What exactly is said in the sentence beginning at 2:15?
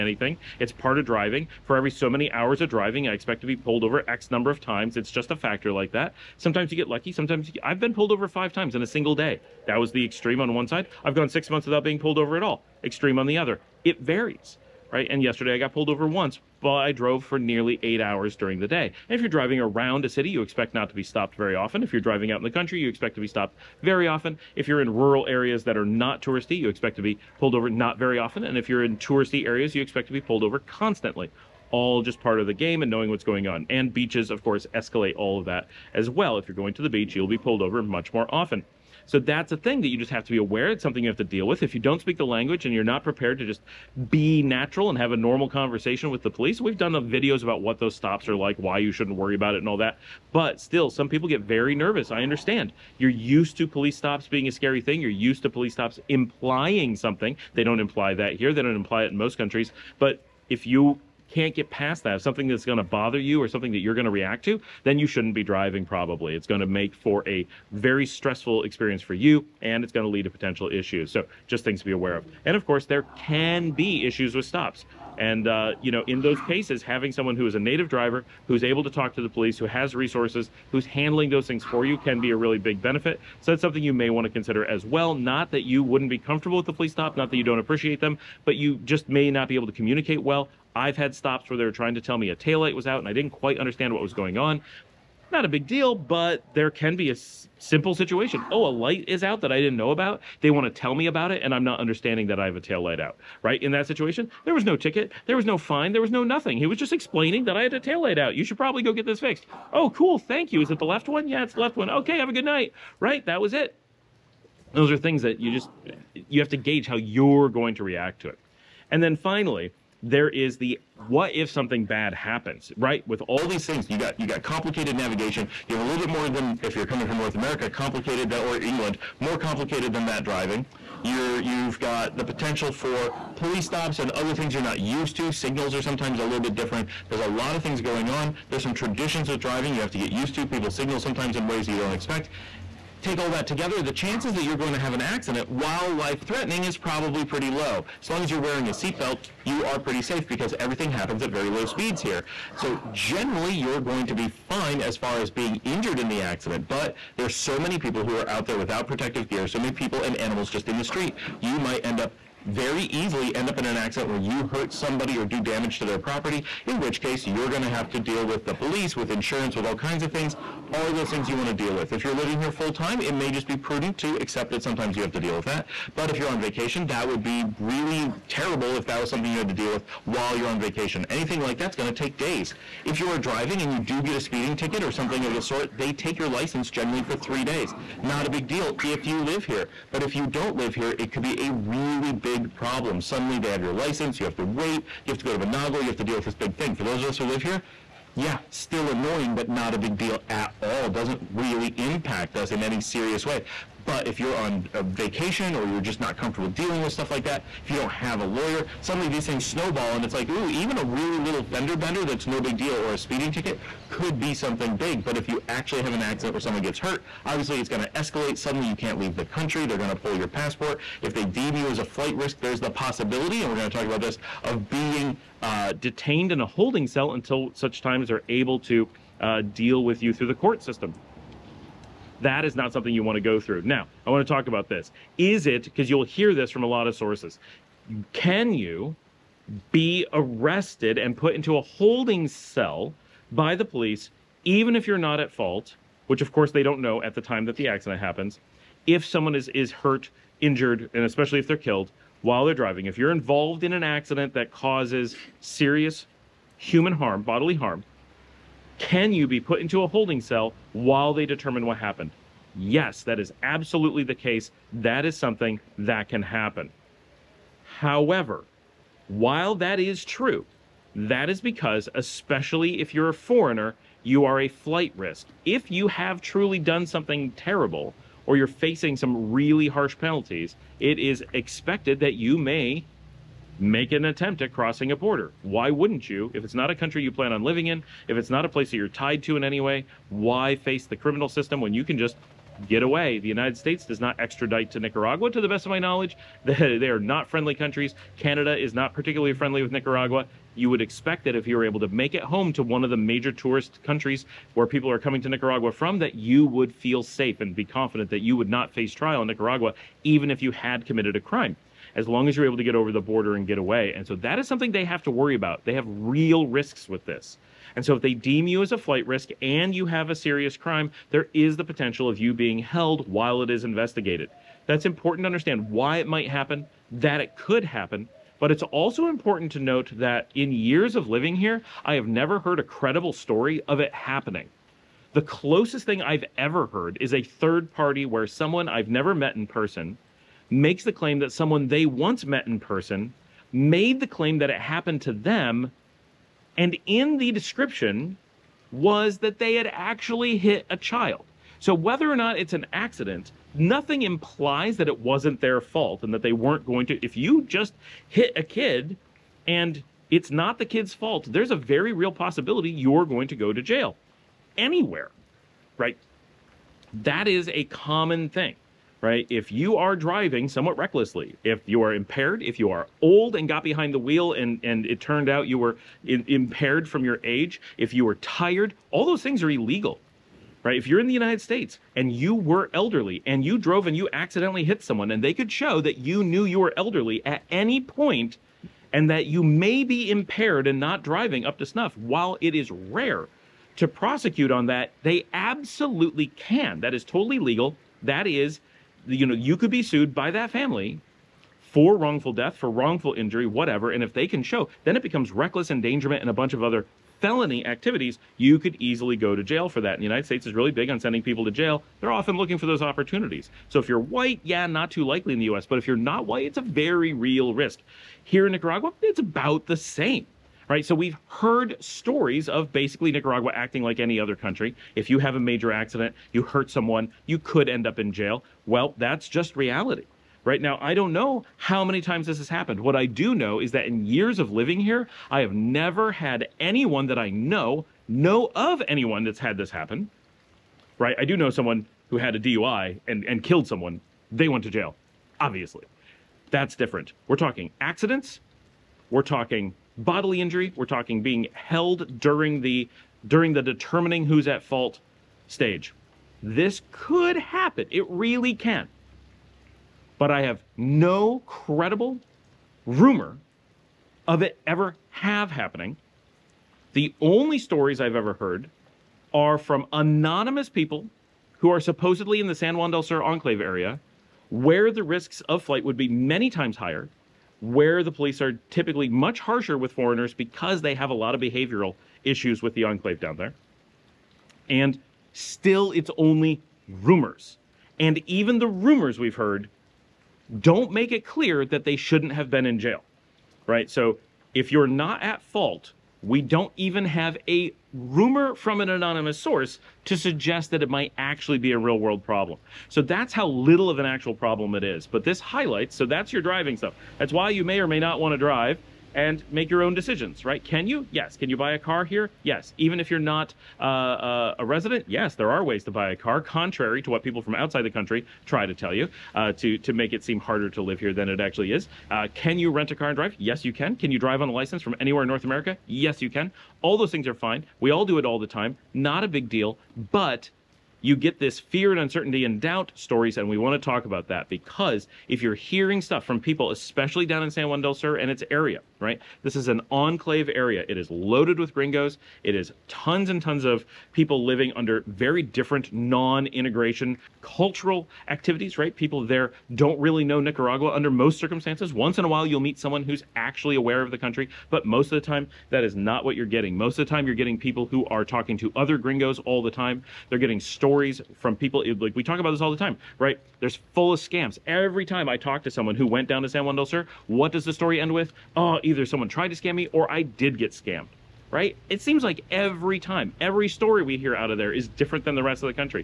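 Signals are sometimes a little bit different.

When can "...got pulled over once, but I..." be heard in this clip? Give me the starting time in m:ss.
0:15.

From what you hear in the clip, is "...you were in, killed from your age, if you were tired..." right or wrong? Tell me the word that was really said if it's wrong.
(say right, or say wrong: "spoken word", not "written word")
wrong: "impaired", not "killed".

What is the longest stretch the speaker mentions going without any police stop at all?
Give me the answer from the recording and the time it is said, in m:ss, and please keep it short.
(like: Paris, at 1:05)
6 months, at 0:11.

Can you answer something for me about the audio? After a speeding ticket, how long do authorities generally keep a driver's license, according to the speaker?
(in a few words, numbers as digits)
3 days.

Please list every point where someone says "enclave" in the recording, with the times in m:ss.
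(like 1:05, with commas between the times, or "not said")
7:53, 8:02, 8:59.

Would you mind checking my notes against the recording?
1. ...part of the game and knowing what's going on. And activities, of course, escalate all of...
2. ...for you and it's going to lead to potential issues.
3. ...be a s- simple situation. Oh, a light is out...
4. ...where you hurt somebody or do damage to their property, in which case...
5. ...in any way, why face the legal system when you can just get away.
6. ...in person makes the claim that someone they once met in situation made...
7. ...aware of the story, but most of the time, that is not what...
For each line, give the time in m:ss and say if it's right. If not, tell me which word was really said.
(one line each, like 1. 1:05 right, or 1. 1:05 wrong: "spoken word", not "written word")
1. 0:32 wrong: "beaches", not "activities"
2. 1:09 right
3. 1:36 right
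4. 2:44 right
5. 4:49 wrong: "criminal", not "legal"
6. 5:39 wrong: "person", not "situation"
7. 9:13 wrong: "country", not "story".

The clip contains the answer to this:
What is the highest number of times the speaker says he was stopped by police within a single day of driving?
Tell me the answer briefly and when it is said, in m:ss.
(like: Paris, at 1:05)
5, at 0:08.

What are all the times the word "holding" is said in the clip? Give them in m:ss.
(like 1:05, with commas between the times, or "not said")
3:46, 4:01, 4:19.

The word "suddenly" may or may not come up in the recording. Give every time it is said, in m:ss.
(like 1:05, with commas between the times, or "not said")
3:13, 3:28, 3:38.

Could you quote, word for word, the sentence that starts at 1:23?
So that's something you may want to consider as well.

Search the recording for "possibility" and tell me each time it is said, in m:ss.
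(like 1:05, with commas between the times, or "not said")
3:42, 6:02.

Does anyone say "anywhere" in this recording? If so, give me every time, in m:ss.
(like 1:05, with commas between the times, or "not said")
6:04, 8:45.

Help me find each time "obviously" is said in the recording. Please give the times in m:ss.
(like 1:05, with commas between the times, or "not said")
3:37, 7:25.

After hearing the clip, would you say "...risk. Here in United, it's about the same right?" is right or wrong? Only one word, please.
wrong.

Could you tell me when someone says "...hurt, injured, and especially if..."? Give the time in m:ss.
4:09.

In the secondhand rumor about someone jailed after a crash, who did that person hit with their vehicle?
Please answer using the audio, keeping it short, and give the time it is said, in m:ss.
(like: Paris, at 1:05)
A child, at 5:50.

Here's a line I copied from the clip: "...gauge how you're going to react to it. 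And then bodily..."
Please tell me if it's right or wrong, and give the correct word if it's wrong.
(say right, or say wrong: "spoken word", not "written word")
wrong: "finally", not "bodily".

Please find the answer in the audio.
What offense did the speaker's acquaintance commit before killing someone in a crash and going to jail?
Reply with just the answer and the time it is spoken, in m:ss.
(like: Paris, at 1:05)
DUI, at 7:22.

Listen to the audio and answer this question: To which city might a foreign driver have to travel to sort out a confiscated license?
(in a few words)
Managua.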